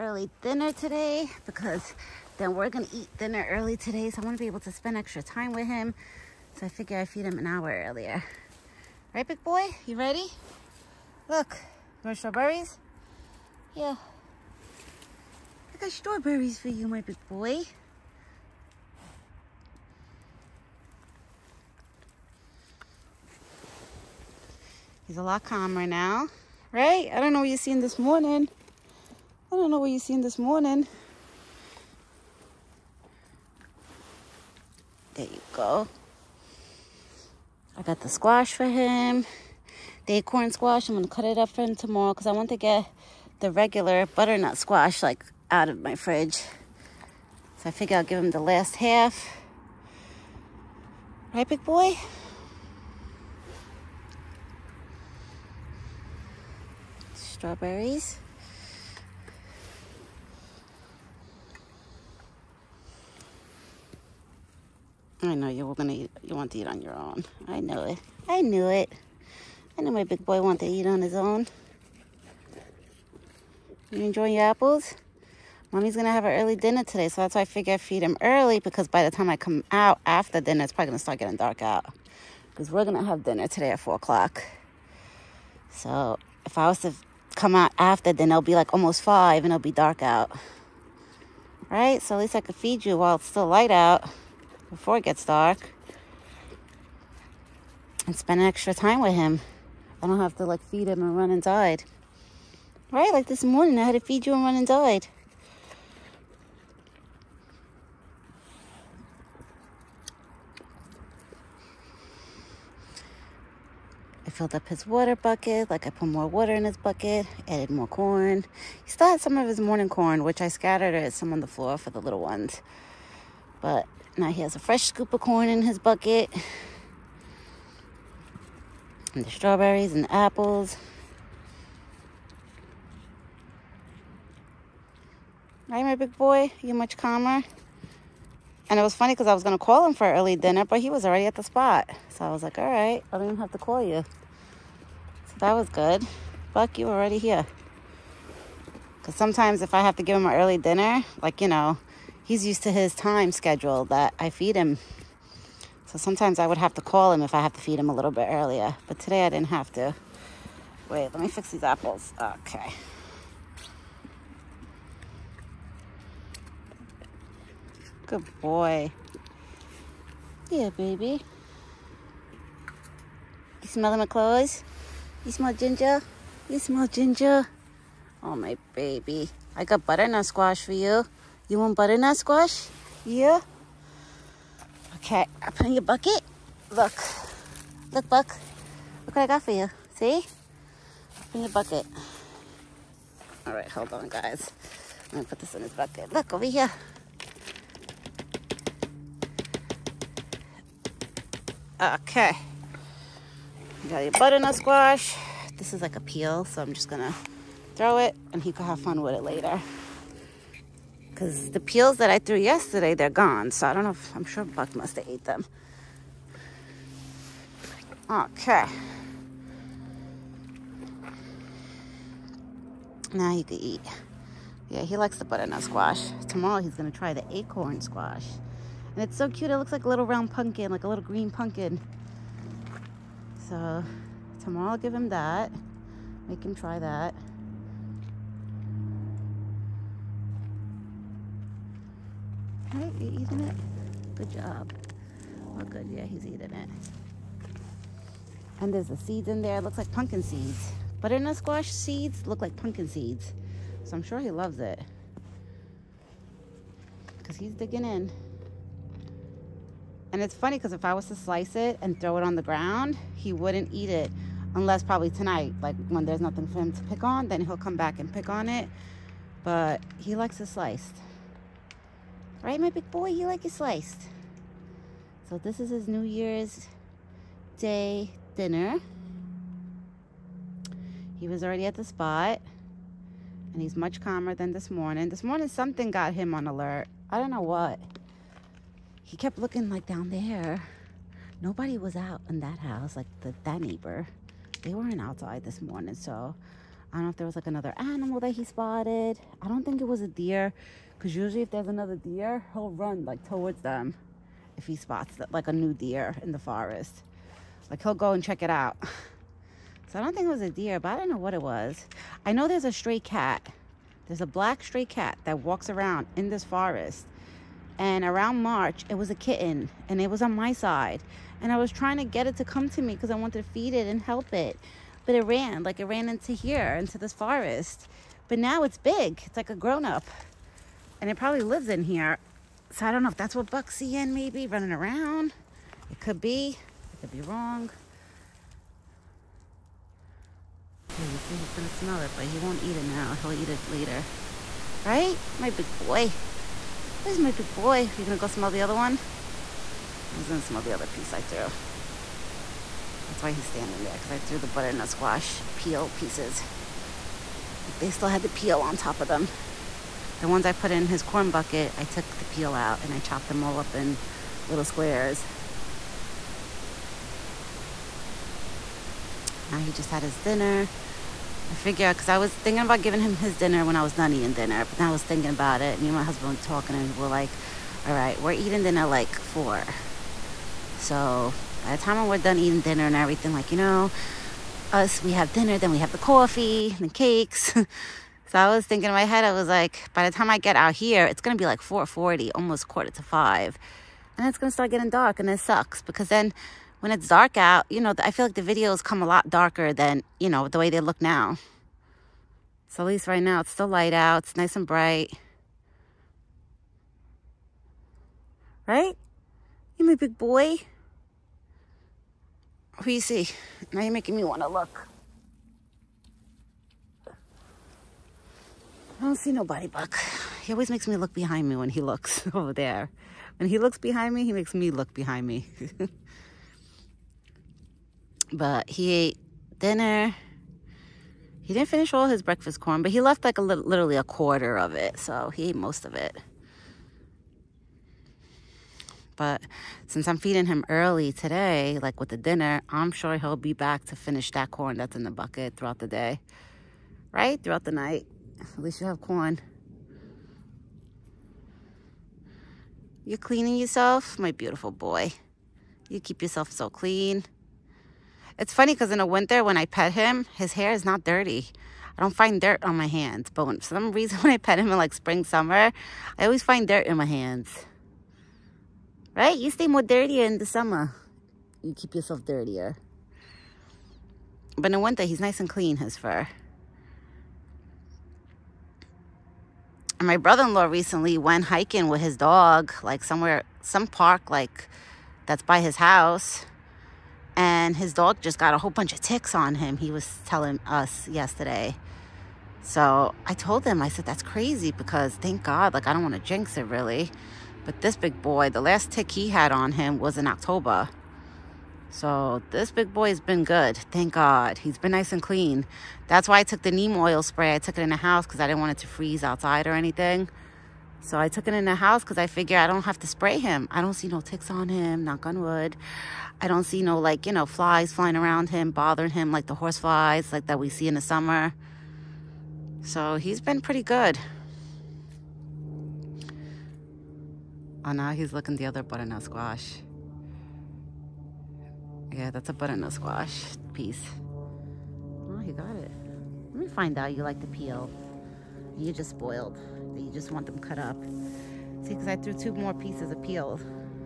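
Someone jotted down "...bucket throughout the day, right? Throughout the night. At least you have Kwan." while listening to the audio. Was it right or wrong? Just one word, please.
right.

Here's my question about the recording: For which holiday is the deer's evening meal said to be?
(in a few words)
New Year's Day.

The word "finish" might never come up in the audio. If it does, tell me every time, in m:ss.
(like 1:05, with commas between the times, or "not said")
7:11, 7:23.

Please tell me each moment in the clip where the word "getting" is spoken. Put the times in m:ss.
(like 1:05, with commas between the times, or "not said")
1:21, 6:34.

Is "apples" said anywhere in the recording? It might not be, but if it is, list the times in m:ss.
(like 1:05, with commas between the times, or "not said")
1:14, 2:10, 2:41.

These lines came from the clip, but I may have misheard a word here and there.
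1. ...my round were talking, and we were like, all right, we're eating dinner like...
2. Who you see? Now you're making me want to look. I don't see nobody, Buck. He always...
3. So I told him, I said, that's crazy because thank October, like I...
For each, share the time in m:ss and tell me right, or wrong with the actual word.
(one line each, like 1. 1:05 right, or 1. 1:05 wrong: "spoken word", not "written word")
1. 6:15 wrong: "husband", not "round"
2. 6:52 right
3. 8:12 wrong: "God", not "October".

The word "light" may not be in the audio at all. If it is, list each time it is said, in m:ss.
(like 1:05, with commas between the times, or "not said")
1:33, 6:43.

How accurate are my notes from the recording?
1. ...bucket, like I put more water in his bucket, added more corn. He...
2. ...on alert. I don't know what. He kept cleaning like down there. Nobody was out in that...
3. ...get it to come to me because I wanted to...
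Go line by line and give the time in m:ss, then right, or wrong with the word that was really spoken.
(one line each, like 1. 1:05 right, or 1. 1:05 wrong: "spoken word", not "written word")
1. 1:55 right
2. 4:46 wrong: "looking", not "cleaning"
3. 5:22 right.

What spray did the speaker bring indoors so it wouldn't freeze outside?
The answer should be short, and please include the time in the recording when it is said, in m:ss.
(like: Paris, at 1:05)
neem oil spray, at 8:26.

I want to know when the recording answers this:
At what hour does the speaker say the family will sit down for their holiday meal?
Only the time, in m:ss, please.
1:23.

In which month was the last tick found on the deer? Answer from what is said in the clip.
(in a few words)
October.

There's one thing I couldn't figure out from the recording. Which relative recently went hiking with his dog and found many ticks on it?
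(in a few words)
brother-in-law.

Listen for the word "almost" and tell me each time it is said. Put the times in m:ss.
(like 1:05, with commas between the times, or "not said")
1:28, 6:32.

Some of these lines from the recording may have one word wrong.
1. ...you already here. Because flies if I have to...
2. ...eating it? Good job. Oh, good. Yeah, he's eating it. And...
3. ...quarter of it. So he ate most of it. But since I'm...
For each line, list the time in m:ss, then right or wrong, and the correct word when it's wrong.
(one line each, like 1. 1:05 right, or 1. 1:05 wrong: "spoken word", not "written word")
1. 2:26 wrong: "sometimes", not "flies"
2. 4:03 right
3. 7:14 right.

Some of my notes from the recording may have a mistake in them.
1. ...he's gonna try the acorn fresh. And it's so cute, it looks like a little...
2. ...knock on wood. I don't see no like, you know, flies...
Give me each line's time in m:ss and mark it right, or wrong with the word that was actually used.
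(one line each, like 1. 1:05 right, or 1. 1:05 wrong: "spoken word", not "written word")
1. 3:46 wrong: "squash", not "fresh"
2. 8:35 right.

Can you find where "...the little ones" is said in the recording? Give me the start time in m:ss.
2:01.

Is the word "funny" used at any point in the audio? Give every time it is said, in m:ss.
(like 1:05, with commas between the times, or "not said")
2:18, 4:20, 7:38.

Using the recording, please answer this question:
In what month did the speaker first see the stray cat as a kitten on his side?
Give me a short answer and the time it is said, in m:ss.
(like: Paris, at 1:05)
March, at 5:18.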